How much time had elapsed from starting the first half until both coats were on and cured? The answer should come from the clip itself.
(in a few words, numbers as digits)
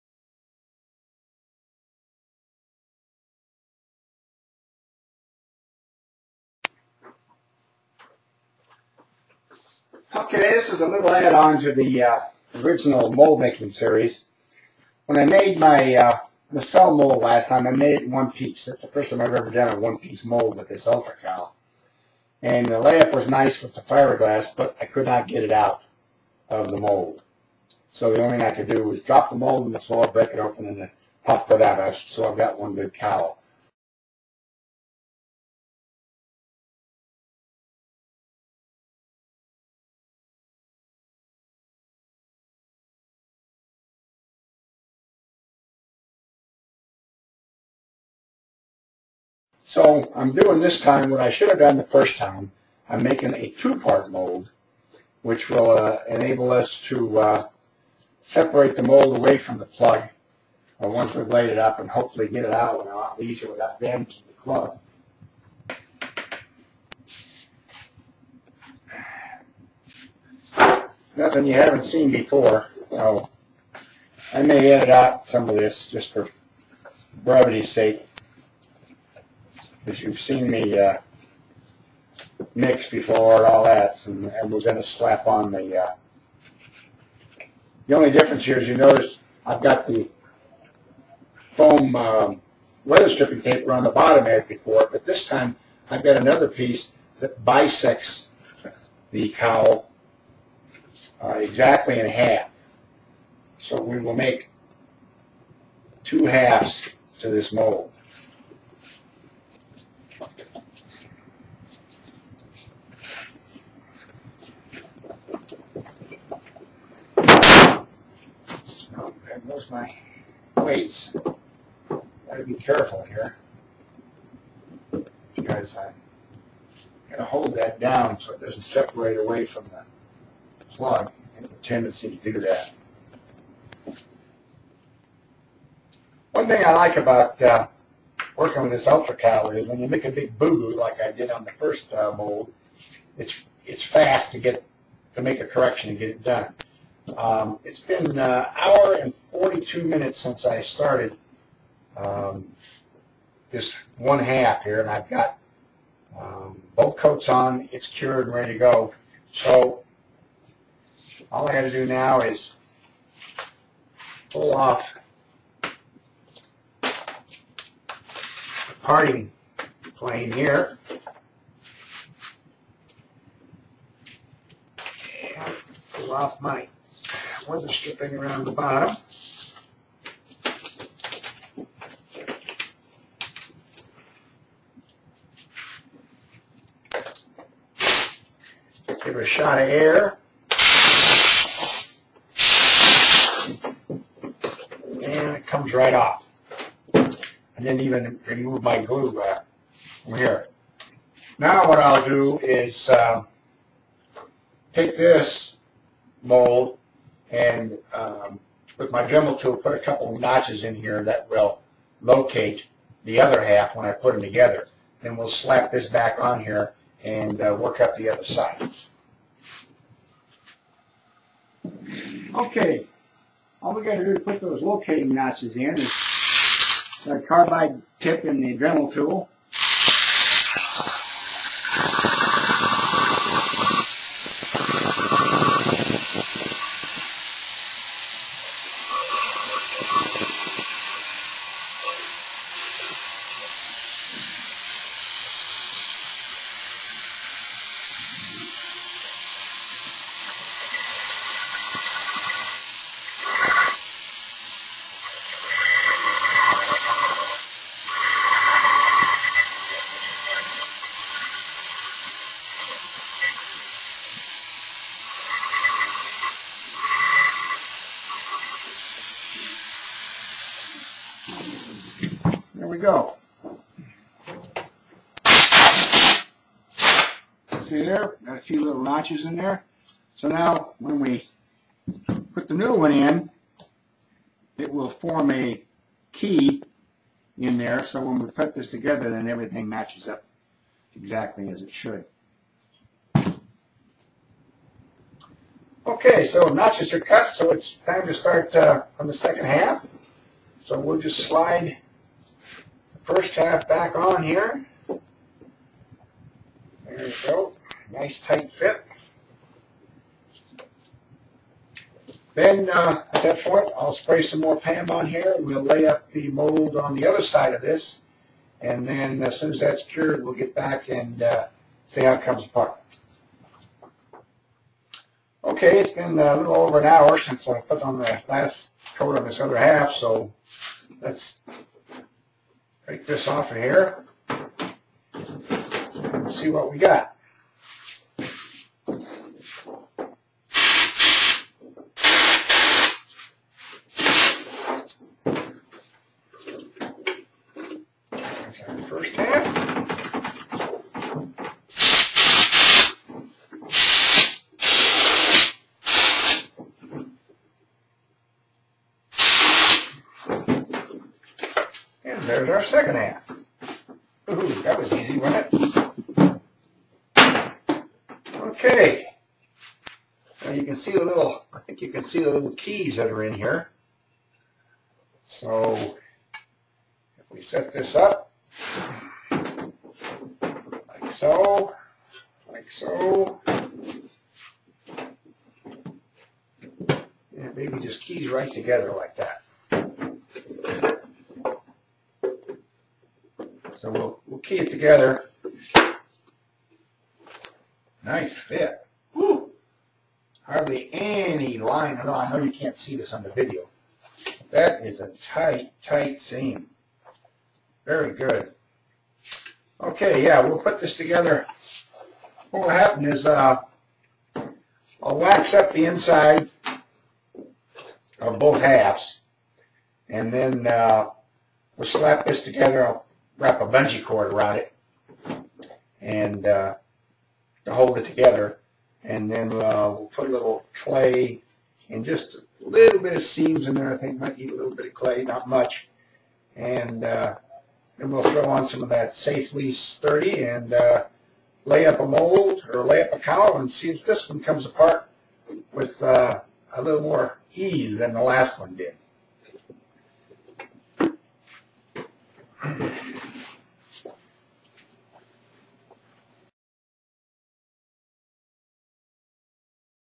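1 hour 42 minutes.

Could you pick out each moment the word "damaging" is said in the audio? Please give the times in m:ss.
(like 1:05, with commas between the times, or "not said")
1:03.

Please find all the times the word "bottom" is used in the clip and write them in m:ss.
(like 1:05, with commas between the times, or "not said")
1:33, 2:58.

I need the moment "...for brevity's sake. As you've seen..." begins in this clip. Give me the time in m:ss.
1:16.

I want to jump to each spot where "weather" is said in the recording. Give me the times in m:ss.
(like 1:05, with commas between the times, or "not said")
1:32, 2:57.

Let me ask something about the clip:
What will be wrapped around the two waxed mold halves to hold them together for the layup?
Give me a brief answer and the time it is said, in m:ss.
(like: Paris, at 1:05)
bungee cord, at 7:03.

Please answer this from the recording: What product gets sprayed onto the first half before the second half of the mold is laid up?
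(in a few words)
PAM.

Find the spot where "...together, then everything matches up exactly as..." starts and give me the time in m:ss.
4:48.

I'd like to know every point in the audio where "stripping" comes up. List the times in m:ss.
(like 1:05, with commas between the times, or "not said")
1:33, 2:57.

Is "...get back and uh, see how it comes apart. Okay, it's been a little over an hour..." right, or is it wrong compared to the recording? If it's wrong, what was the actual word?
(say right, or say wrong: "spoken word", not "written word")
right.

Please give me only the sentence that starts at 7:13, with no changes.
I think might need a little bit of clay, not much.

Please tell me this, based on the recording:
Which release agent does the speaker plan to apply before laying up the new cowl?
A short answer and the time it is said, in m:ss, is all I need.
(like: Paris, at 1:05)
Safe Lease 30, at 7:19.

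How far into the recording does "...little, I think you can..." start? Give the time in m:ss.
6:11.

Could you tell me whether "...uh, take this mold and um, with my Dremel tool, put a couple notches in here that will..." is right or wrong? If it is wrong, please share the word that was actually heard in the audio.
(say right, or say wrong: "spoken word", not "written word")
right.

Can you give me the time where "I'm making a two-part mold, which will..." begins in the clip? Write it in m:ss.
0:52.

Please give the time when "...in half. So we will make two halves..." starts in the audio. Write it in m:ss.
1:41.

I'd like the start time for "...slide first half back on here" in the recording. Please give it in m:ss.
5:01.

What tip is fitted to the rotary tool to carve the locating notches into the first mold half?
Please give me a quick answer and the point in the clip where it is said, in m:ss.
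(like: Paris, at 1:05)
carbide tip, at 3:47.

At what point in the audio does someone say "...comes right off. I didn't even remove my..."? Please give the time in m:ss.
3:15.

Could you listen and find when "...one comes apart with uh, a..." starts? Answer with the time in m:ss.
7:24.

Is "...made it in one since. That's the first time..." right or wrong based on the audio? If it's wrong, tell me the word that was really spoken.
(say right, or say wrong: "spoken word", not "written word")
wrong: "piece", not "since".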